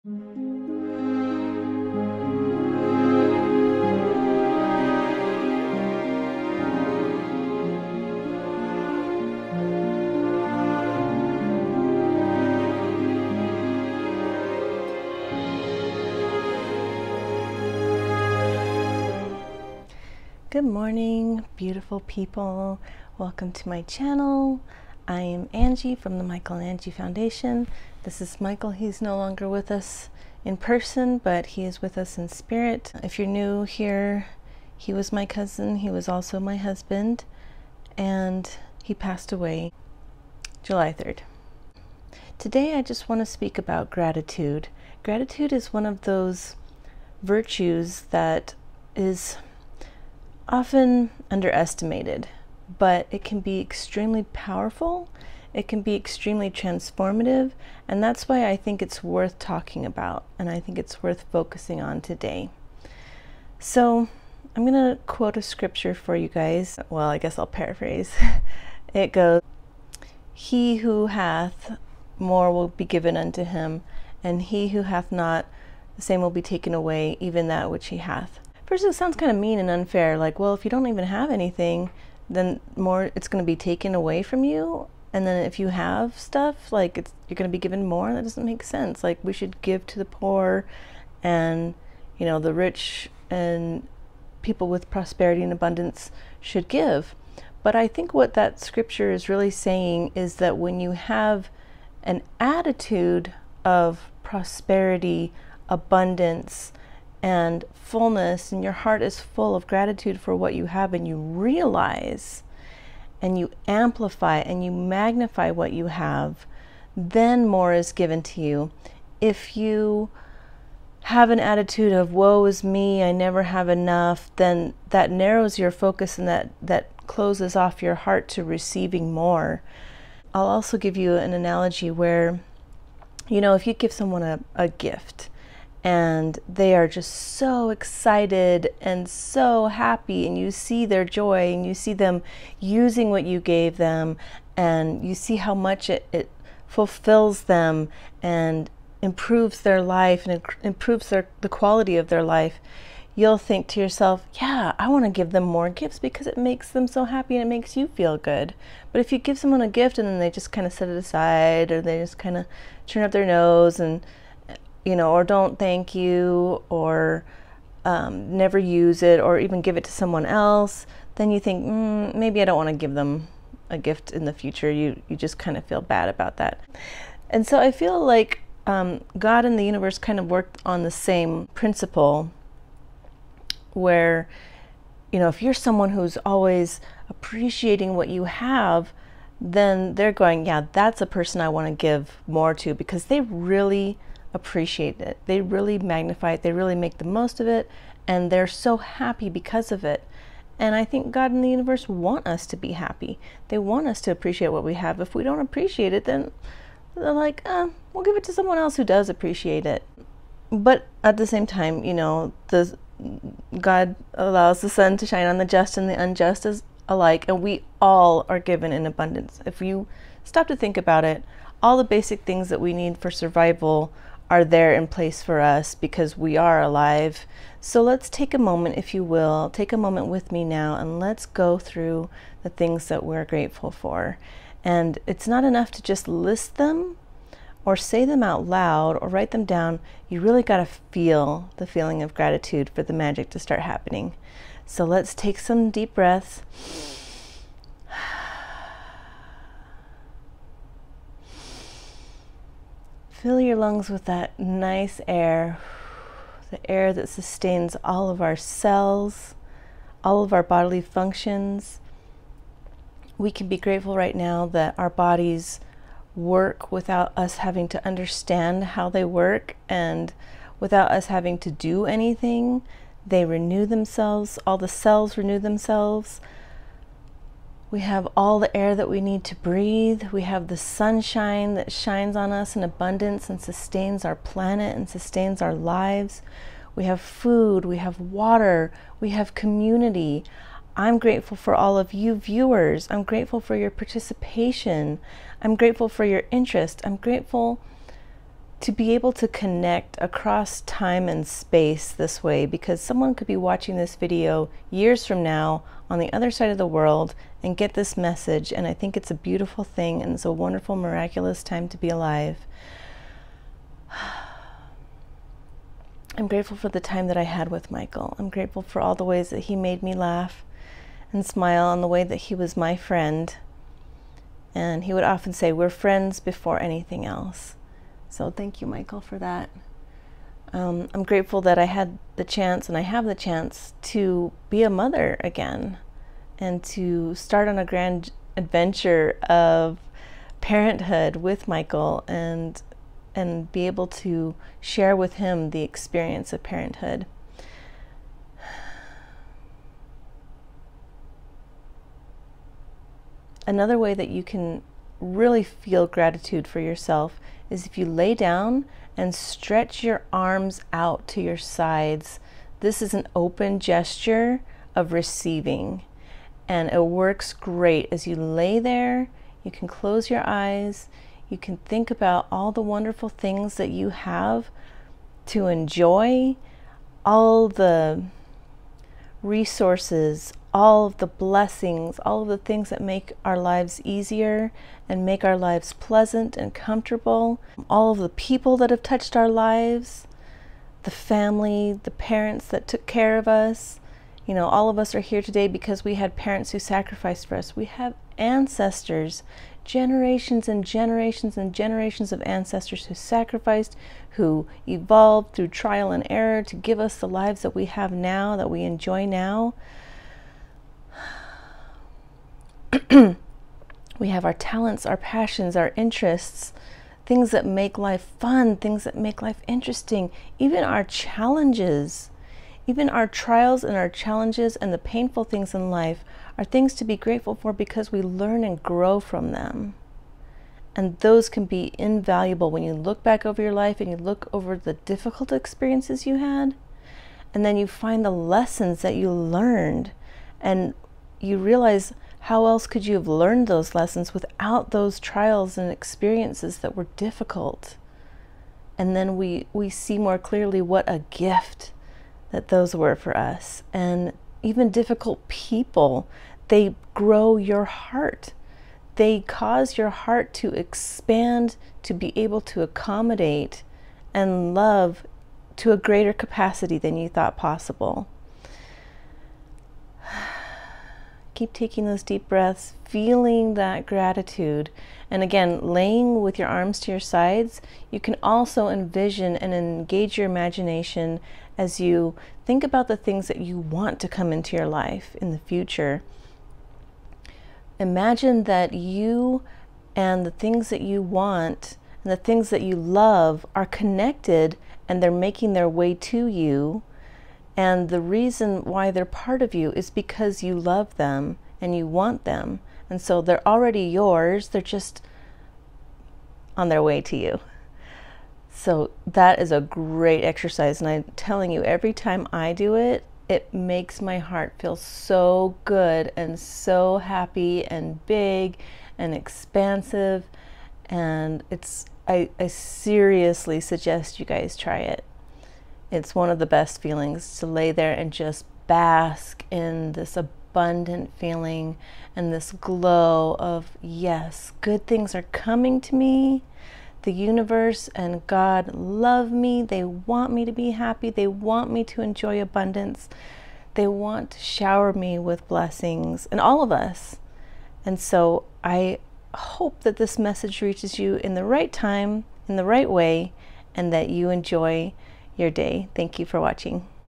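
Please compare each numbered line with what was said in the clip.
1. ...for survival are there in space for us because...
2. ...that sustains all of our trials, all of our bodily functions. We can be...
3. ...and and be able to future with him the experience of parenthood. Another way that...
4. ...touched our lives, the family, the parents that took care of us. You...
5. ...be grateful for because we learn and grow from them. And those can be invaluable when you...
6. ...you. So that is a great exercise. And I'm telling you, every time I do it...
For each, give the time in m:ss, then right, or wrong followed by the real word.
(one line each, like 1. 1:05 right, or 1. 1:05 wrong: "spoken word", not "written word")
1. 3:42 wrong: "place", not "space"
2. 4:16 wrong: "cells", not "trials"
3. 5:42 wrong: "share", not "future"
4. 6:28 right
5. 7:06 right
6. 8:27 right.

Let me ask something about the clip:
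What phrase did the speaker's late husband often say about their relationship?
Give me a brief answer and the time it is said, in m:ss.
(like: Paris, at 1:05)
We're friends before anything else, at 5:25.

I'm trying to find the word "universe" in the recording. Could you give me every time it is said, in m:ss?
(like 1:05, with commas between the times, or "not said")
2:59, 3:21, 8:57.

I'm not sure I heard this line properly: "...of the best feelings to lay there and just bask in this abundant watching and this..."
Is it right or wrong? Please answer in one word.
wrong.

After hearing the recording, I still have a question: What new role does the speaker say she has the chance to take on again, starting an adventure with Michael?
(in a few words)
mother.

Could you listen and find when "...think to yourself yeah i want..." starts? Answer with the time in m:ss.
2:33.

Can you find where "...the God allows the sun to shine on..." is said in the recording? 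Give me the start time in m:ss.
3:32.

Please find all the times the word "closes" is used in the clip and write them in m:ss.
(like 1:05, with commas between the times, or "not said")
2:07, 6:09.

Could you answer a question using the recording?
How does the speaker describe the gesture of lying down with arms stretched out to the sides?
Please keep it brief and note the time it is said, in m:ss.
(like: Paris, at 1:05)
open gesture of receiving, at 6:03.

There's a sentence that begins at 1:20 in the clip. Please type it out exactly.
Like, well, if you don't even have anything, then more it's going to be taken away from you.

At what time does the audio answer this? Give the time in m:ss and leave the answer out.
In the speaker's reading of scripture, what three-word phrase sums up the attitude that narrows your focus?
2:02.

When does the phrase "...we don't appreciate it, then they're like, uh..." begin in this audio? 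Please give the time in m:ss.
3:25.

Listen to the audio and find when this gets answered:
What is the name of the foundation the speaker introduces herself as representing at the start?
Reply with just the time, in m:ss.
0:26.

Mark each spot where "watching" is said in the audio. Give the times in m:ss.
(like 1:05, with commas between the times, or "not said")
5:03, 9:16.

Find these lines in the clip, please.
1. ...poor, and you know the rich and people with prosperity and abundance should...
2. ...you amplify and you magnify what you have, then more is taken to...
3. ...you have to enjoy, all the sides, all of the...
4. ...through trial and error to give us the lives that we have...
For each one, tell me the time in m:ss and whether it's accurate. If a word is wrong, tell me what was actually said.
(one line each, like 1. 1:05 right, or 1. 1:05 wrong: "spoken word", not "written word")
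1. 1:30 right
2. 1:53 wrong: "given", not "taken"
3. 6:13 wrong: "resources", not "sides"
4. 6:45 right.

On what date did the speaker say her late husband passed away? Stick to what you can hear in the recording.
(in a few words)
July 3rd.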